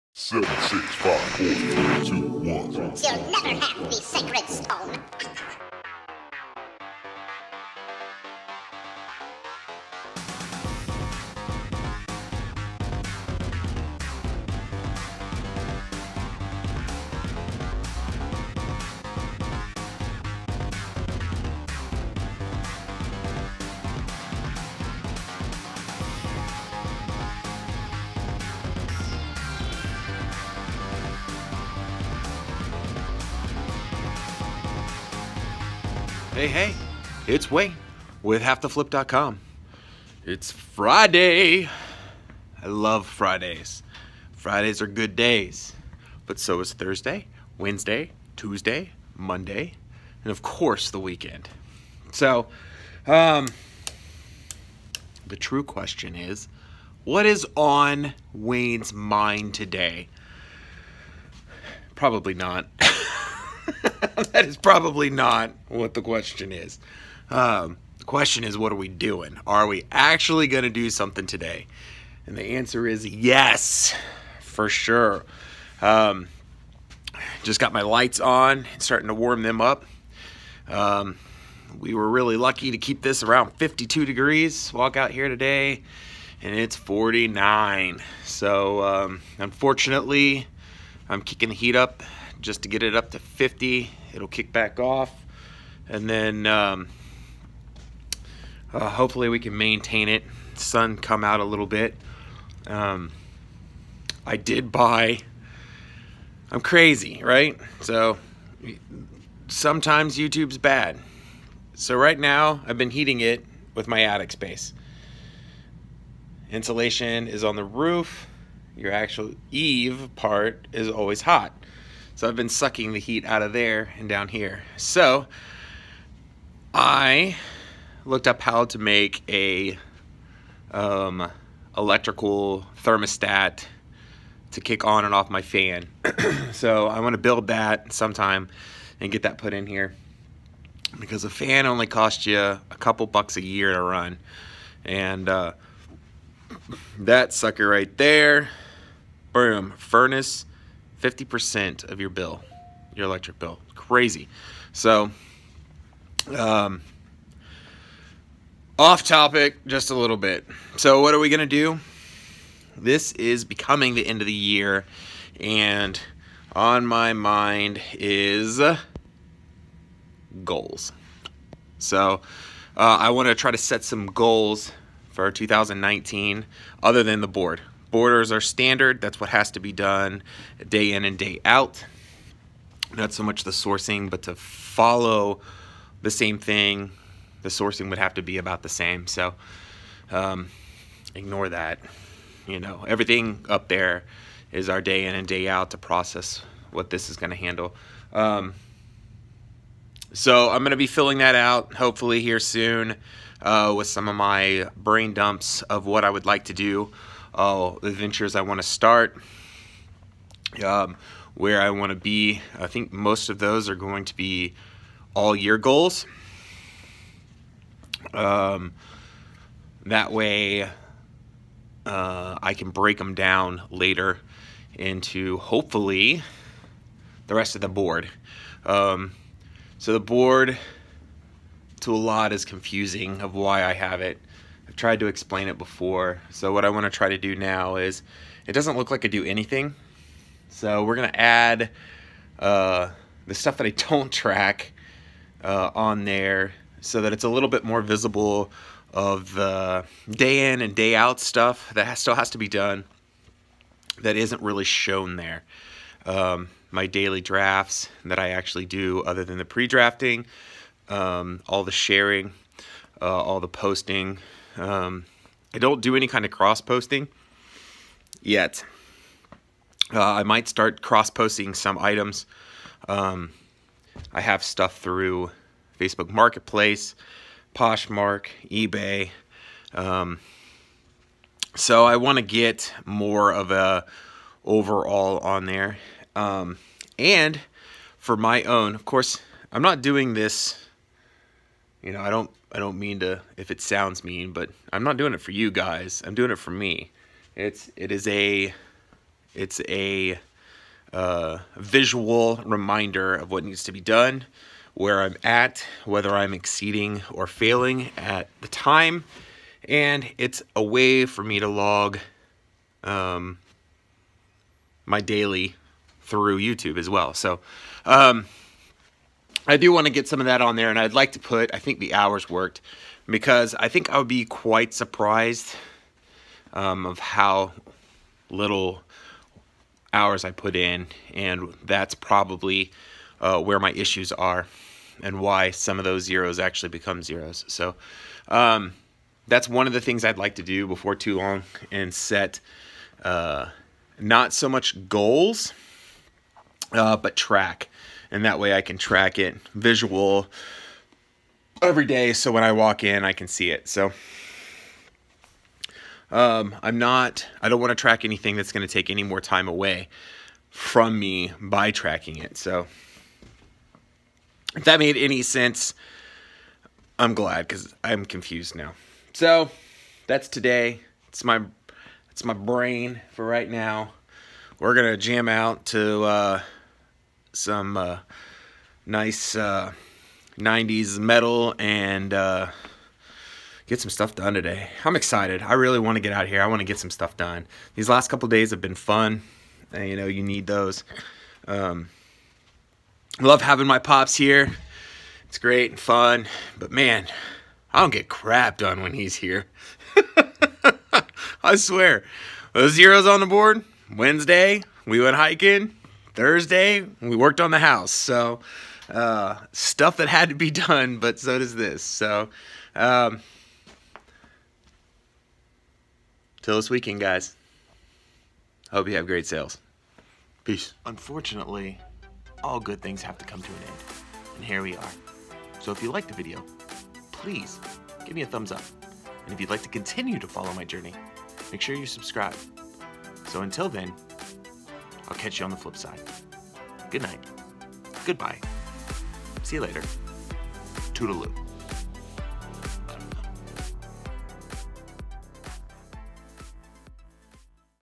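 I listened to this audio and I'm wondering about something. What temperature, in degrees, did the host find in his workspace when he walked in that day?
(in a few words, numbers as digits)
49.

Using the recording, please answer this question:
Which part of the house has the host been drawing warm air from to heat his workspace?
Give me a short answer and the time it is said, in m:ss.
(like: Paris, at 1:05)
attic space, at 1:54.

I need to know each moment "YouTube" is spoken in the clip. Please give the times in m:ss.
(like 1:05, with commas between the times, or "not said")
1:50, 5:16.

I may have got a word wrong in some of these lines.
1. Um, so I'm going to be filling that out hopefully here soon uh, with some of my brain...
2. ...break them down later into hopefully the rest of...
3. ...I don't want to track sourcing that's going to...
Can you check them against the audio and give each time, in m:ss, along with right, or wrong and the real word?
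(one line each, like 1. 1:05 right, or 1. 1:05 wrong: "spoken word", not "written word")
1. 3:18 right
2. 3:42 right
3. 5:57 wrong: "anything", not "sourcing".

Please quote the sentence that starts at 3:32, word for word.
I think most of those are going to be all year goals.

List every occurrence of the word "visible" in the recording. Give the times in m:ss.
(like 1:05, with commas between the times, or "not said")
4:07.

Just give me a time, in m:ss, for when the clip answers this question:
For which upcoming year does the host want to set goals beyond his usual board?
2:55.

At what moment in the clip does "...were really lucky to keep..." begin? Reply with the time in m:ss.
1:21.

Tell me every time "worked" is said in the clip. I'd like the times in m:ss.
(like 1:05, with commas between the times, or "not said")
5:22, 6:47.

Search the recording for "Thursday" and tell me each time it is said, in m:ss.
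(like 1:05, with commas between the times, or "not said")
0:46, 6:46.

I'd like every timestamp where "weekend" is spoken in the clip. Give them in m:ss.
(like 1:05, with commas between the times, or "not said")
0:51, 6:56.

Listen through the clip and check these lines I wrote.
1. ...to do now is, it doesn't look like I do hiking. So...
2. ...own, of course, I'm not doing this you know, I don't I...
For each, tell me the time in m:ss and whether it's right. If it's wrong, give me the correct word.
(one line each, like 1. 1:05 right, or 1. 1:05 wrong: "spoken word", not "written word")
1. 3:57 wrong: "anything", not "hiking"
2. 4:48 right.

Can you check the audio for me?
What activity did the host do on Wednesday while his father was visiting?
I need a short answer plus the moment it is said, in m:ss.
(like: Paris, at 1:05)
hiking, at 6:45.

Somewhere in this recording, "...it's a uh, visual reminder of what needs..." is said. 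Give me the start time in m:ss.
4:59.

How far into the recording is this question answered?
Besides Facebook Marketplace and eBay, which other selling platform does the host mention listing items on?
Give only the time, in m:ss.
4:37.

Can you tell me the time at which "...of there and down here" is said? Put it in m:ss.
2:03.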